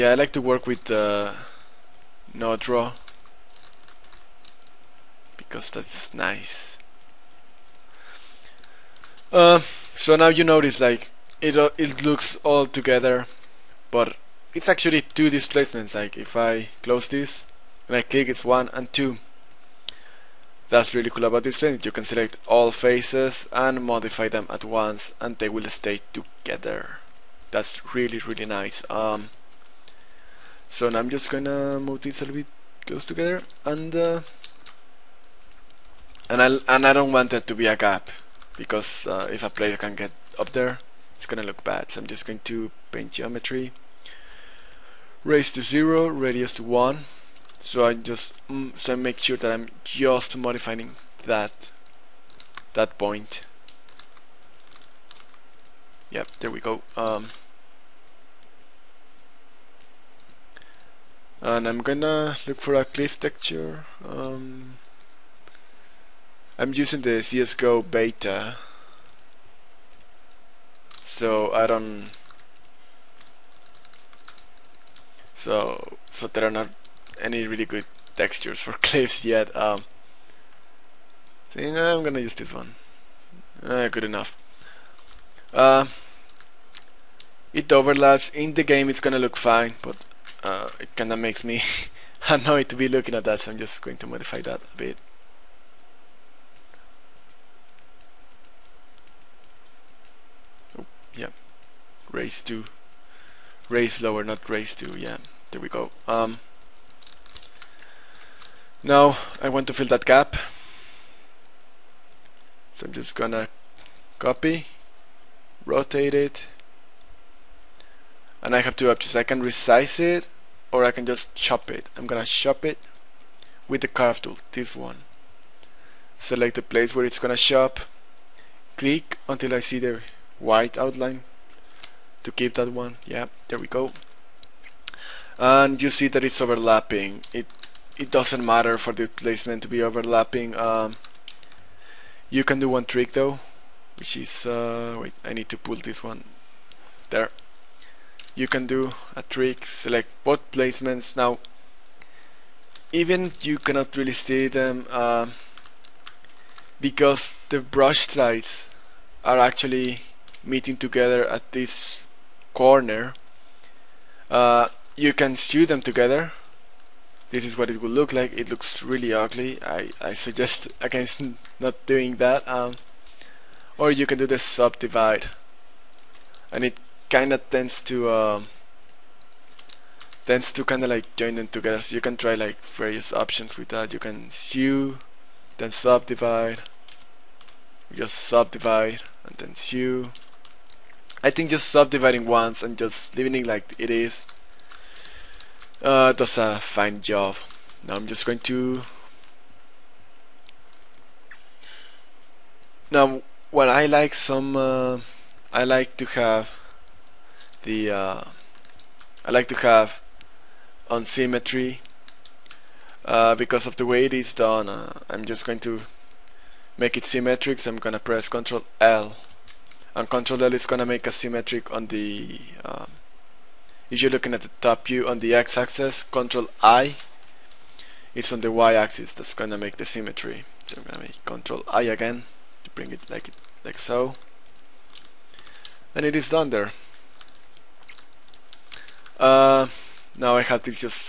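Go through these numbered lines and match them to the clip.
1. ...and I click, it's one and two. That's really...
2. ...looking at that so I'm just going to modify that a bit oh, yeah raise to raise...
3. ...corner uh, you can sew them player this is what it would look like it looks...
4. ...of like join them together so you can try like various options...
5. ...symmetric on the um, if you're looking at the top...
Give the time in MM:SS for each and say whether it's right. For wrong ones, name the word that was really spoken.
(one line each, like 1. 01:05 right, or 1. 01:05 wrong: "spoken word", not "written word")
1. 00:17 right
2. 01:32 right
3. 02:42 wrong: "together", not "player"
4. 03:00 right
5. 03:41 right.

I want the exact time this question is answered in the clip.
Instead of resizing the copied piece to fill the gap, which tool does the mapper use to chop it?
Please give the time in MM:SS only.
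02:03.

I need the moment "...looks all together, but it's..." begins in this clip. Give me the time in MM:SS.
00:12.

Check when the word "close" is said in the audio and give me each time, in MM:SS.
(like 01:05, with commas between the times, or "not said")
00:16, 00:32.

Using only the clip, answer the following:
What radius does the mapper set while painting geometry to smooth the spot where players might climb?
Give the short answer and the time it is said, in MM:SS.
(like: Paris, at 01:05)
1, at 00:46.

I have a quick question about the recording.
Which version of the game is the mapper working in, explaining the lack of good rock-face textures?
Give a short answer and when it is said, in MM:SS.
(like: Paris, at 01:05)
CSGO beta, at 01:07.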